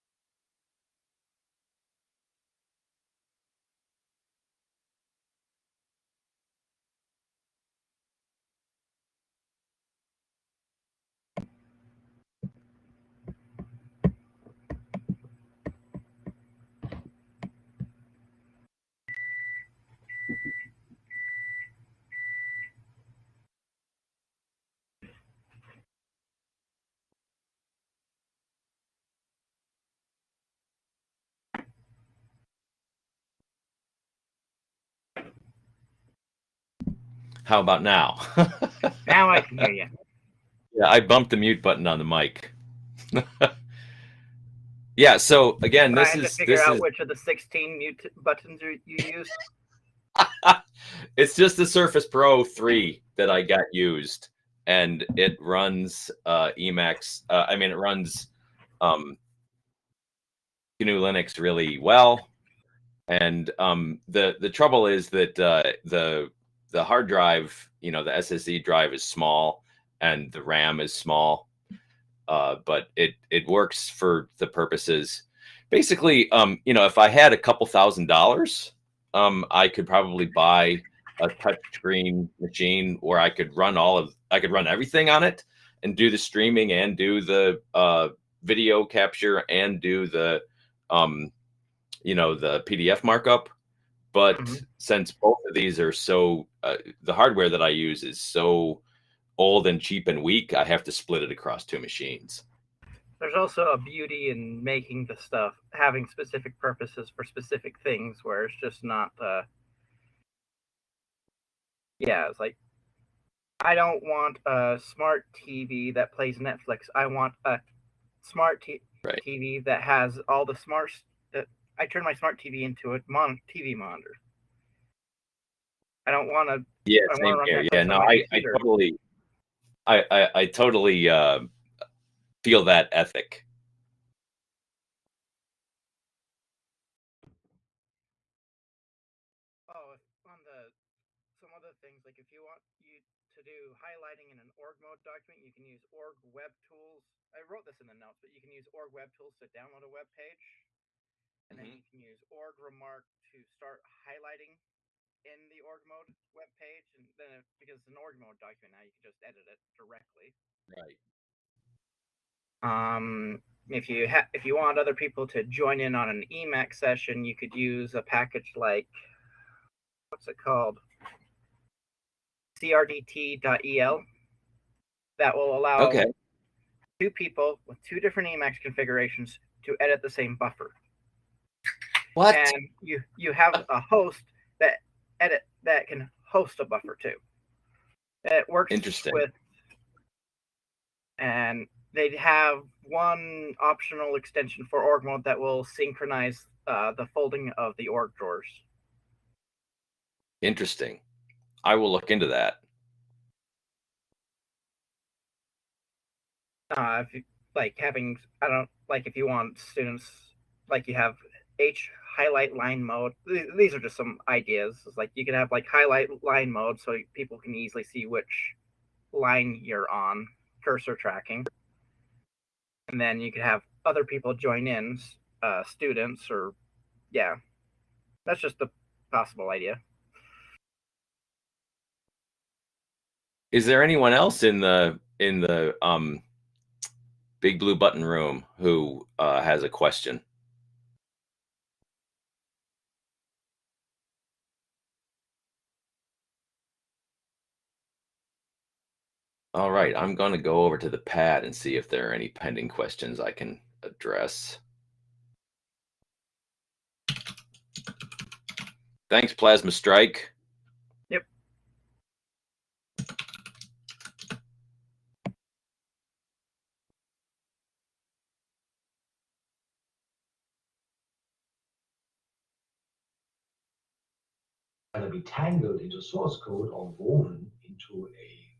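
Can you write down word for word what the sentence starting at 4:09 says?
All right, I'm going to go over to the pad and see if there are any pending questions I can address.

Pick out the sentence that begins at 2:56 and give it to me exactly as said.
two people with two different emacs configurations to edit the same buffer what?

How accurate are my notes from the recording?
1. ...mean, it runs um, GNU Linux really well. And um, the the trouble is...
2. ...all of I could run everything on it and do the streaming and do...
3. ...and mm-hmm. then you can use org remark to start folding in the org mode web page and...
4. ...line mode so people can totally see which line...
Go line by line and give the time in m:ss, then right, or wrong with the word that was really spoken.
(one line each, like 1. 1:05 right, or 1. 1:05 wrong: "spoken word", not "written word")
1. 0:57 right
2. 1:23 right
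3. 2:31 wrong: "highlighting", not "folding"
4. 3:36 wrong: "easily", not "totally".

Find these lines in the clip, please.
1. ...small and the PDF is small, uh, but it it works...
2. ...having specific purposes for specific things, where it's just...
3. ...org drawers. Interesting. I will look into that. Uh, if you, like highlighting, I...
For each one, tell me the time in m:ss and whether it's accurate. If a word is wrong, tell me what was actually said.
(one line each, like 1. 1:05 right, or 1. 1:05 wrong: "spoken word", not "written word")
1. 1:09 wrong: "RAM", not "PDF"
2. 1:45 right
3. 3:17 wrong: "having", not "highlighting".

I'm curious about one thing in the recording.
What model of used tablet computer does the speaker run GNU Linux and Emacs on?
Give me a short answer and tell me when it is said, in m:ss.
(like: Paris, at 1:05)
Surface Pro 3, at 0:51.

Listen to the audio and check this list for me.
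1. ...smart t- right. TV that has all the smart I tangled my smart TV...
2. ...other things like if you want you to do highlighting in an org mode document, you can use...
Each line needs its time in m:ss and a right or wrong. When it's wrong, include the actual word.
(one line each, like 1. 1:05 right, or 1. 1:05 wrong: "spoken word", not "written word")
1. 1:58 wrong: "turned", not "tangled"
2. 2:21 right.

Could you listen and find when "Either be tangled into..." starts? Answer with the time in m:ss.
4:34.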